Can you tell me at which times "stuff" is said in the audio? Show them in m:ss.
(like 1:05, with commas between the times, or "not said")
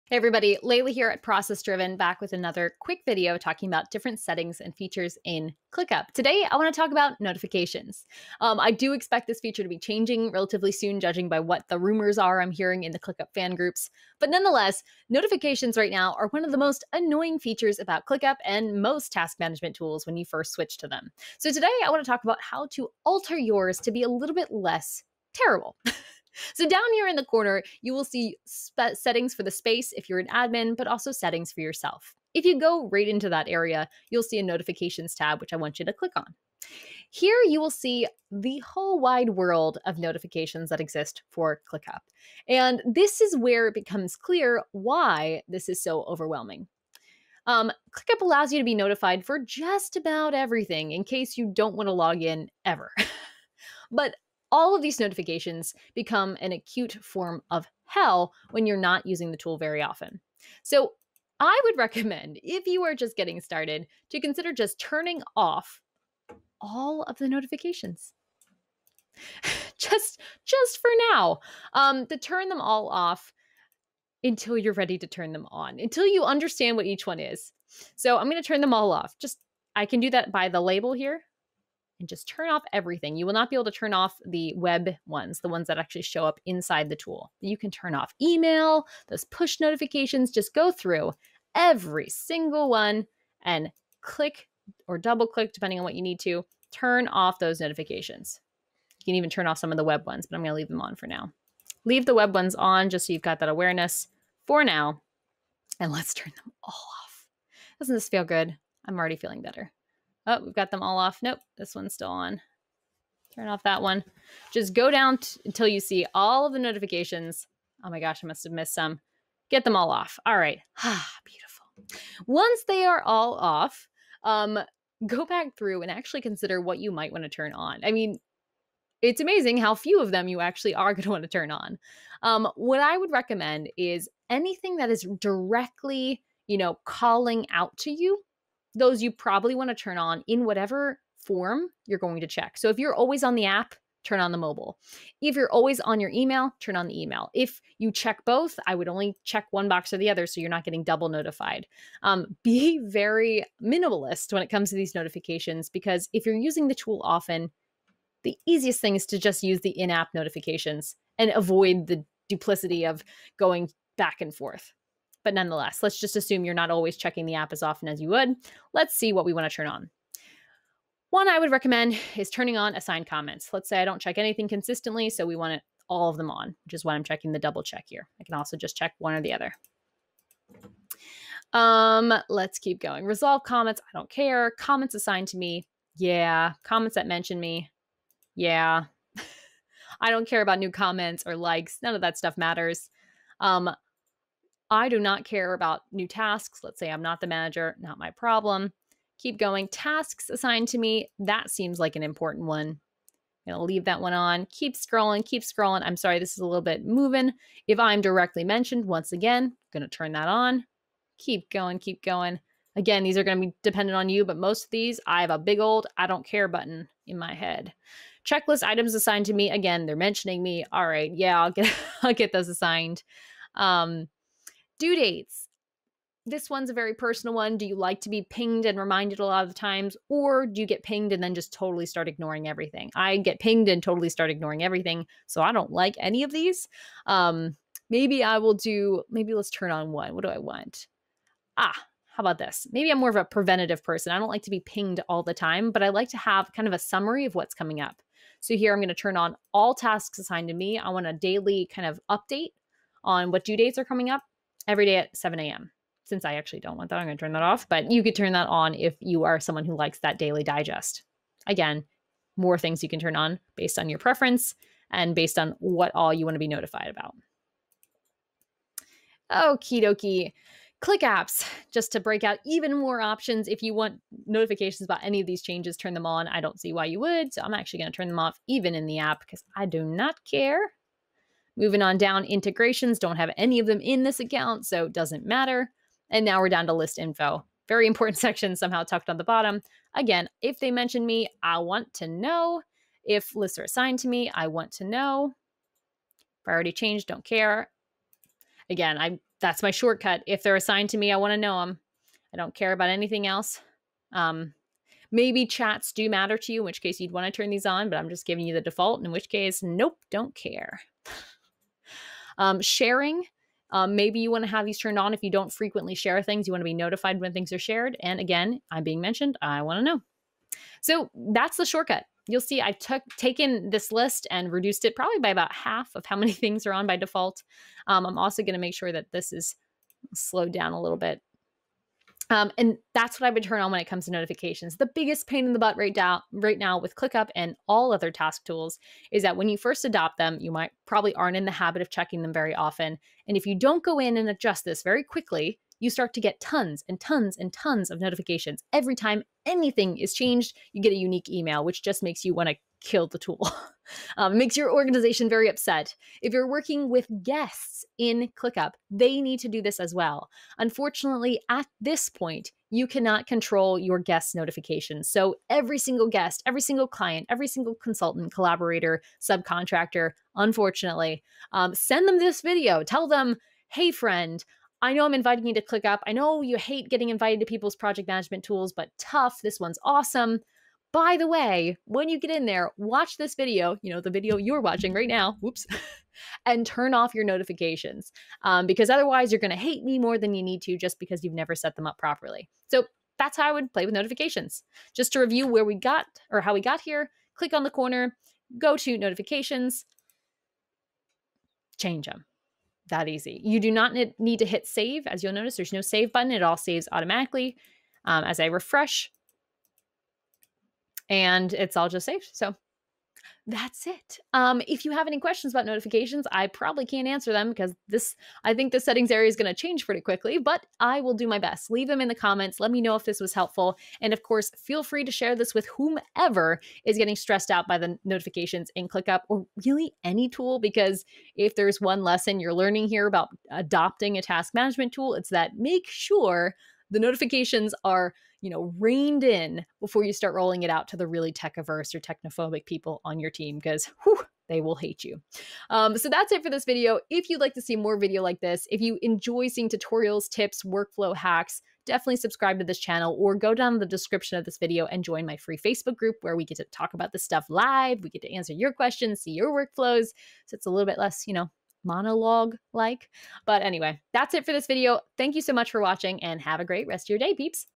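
3:12, 7:37.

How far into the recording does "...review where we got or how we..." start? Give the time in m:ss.
6:35.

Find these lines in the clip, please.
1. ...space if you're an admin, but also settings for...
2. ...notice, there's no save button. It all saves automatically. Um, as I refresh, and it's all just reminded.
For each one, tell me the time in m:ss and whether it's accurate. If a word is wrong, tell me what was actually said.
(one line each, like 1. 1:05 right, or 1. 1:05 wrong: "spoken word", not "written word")
1. 0:29 right
2. 6:45 wrong: "saved", not "reminded".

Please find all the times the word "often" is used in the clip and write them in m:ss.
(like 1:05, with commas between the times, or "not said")
0:59, 2:37, 2:47, 5:42.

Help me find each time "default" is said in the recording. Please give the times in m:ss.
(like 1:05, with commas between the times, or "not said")
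5:08, 5:26.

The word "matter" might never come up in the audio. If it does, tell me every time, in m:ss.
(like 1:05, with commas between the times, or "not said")
3:12, 4:45, 5:06.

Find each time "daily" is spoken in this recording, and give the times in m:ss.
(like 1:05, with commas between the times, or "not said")
4:11, 4:20.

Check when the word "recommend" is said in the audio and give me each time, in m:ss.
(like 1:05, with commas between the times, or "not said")
1:01, 2:13, 2:51.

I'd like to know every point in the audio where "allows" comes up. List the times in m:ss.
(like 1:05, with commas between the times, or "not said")
0:48.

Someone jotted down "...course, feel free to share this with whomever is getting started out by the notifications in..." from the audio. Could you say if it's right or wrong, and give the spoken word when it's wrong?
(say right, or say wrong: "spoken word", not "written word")
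wrong: "stressed", not "started".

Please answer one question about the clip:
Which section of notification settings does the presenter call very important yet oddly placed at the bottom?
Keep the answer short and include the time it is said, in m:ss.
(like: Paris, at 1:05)
list info, at 4:46.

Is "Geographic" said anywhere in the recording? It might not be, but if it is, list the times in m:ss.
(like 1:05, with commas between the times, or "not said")
not said.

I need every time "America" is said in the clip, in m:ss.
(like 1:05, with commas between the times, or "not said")
not said.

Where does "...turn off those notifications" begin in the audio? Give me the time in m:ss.
1:36.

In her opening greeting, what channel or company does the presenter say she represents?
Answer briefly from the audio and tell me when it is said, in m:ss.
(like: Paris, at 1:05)
Process Driven, at 0:01.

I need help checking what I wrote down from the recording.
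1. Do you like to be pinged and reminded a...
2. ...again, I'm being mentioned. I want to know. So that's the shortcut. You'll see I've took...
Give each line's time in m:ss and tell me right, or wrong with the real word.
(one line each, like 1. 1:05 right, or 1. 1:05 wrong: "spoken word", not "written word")
1. 3:47 right
2. 5:18 right.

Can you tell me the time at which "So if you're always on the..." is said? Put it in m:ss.
2:22.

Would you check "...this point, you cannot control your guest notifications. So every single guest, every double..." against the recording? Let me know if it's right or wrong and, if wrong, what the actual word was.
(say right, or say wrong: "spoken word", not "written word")
wrong: "single", not "double".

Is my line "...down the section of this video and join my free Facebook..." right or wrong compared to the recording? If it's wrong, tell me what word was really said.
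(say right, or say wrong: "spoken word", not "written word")
wrong: "description", not "section".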